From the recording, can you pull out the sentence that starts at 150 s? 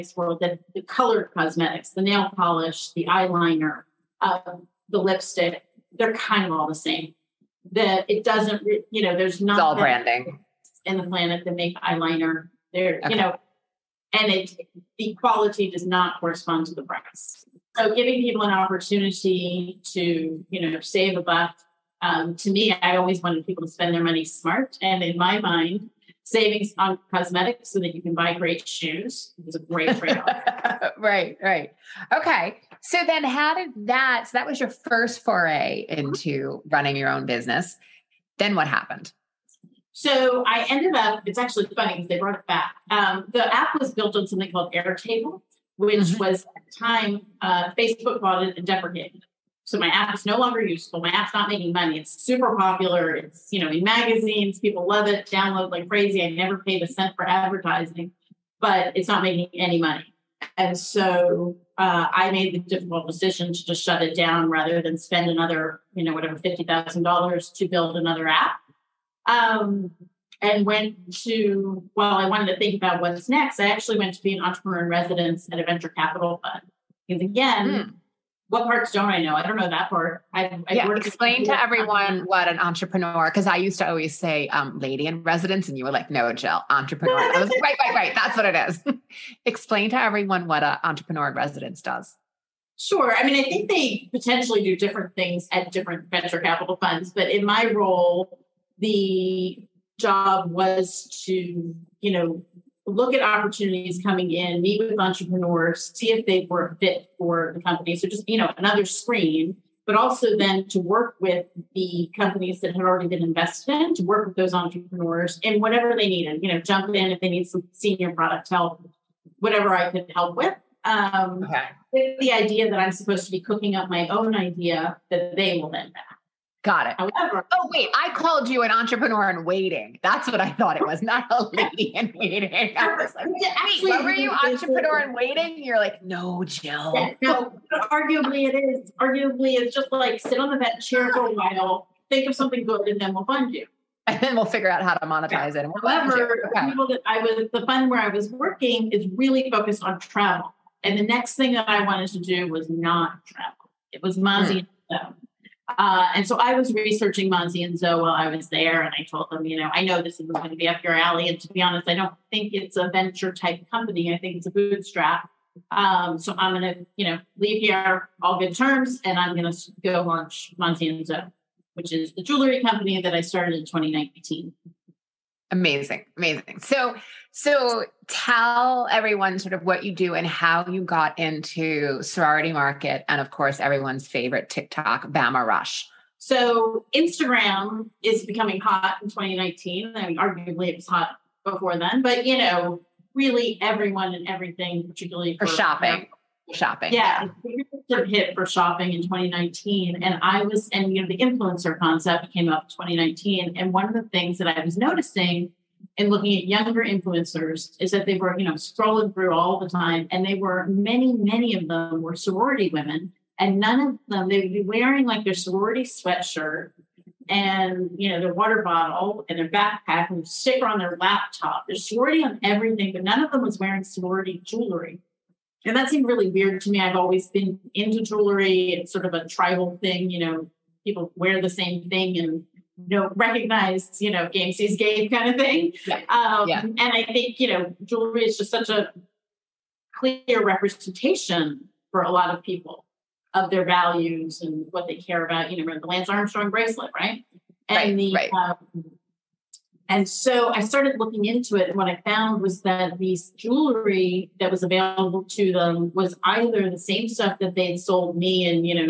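And the next thing that I wanted to do was not travel.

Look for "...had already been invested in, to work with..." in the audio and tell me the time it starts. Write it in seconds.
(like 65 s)
112 s.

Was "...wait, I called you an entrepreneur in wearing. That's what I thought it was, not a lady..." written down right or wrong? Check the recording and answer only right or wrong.
wrong.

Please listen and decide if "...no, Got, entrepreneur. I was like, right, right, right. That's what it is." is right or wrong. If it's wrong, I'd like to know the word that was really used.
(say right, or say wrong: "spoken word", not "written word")
wrong: "Jill", not "Got".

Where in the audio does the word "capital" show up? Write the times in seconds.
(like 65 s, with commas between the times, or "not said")
75 s, 96 s.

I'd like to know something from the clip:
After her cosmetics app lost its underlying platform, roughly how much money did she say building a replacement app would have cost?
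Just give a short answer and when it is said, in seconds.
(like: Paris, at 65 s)
$50,000, at 66 s.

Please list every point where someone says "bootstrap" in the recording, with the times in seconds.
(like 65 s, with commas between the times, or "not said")
164 s.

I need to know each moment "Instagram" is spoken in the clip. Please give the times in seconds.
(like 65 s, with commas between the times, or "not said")
186 s.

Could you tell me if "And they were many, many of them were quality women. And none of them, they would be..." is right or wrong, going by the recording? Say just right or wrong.
wrong.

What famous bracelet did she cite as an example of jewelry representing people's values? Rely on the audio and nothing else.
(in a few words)
Lance Armstrong bracelet.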